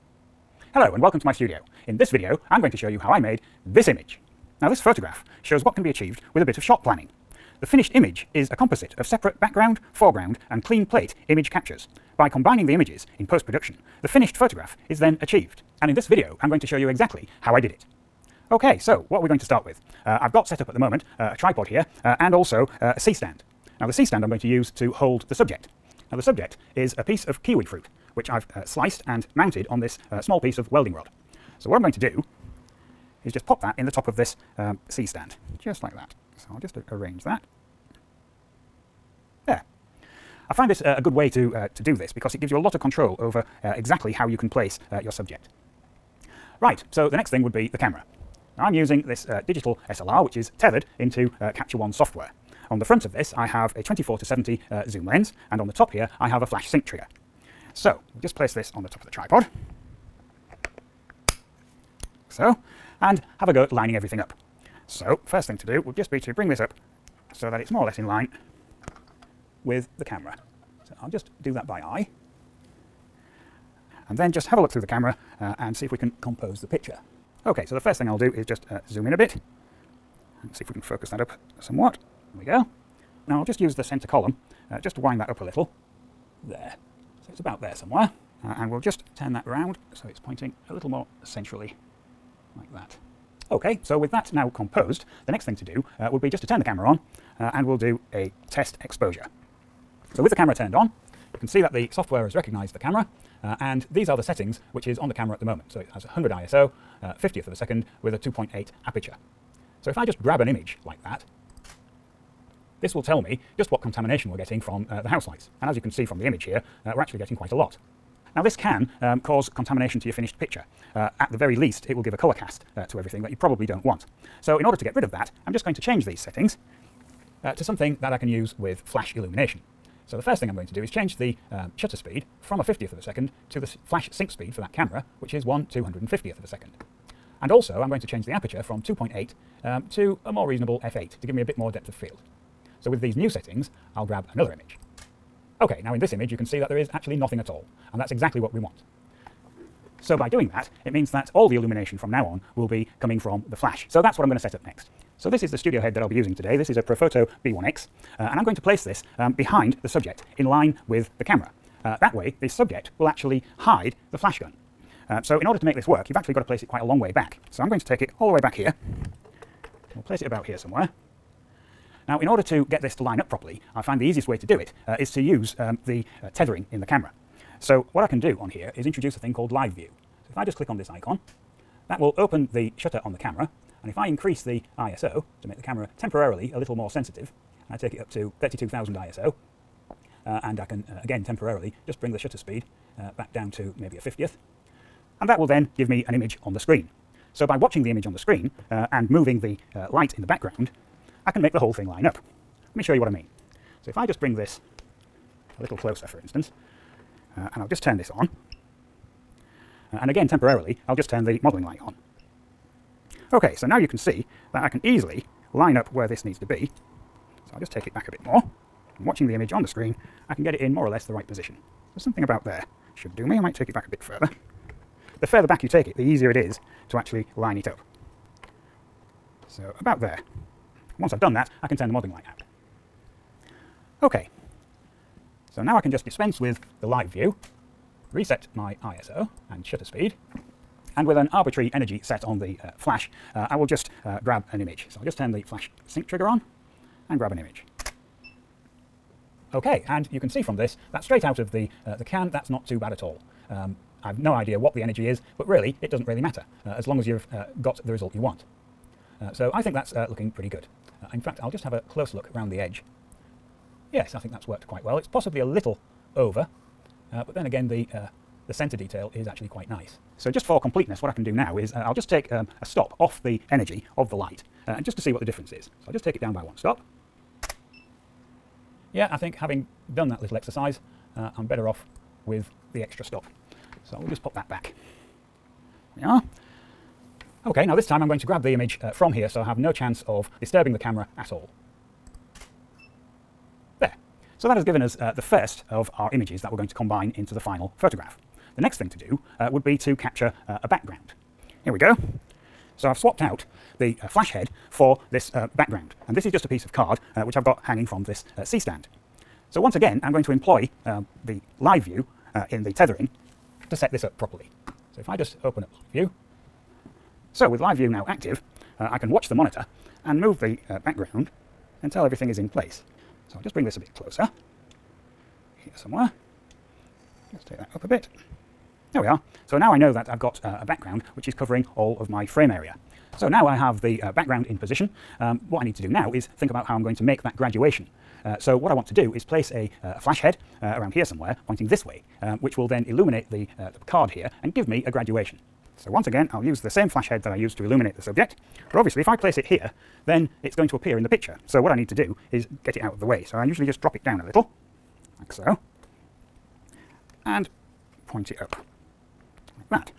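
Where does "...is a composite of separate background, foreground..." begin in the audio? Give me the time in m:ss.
0:08.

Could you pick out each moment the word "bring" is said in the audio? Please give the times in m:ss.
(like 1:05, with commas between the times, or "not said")
1:06, 3:11, 3:24, 5:23.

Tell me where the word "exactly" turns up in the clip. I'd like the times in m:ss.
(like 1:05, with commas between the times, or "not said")
0:16, 0:43, 2:28.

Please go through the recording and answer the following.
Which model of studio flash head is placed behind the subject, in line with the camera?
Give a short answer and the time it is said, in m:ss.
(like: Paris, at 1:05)
Profoto B1X, at 2:36.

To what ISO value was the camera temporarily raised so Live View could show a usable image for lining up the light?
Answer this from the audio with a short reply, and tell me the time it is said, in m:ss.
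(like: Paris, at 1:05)
32,000, at 3:08.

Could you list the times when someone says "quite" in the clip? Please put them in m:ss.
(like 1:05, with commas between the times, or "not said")
1:57, 2:46, 4:24, 4:29.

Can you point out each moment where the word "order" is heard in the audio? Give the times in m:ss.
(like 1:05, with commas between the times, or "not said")
2:04, 2:45, 2:52.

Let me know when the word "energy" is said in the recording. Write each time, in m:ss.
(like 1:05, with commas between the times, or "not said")
4:01, 4:14, 4:33.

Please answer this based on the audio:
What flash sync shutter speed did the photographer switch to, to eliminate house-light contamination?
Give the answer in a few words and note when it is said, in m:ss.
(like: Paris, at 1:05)
1/250th of a second, at 2:15.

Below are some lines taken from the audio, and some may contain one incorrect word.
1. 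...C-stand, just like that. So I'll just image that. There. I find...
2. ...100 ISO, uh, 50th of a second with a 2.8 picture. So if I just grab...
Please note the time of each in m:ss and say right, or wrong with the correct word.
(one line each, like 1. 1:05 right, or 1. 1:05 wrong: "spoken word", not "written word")
1. 0:34 wrong: "arrange", not "image"
2. 1:46 wrong: "aperture", not "picture".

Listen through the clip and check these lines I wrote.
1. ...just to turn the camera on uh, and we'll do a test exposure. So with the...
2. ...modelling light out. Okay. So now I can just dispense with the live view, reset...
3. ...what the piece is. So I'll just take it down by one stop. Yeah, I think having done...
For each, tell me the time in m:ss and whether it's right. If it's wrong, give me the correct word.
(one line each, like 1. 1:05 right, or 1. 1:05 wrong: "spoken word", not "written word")
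1. 1:36 right
2. 3:51 right
3. 4:35 wrong: "difference", not "piece".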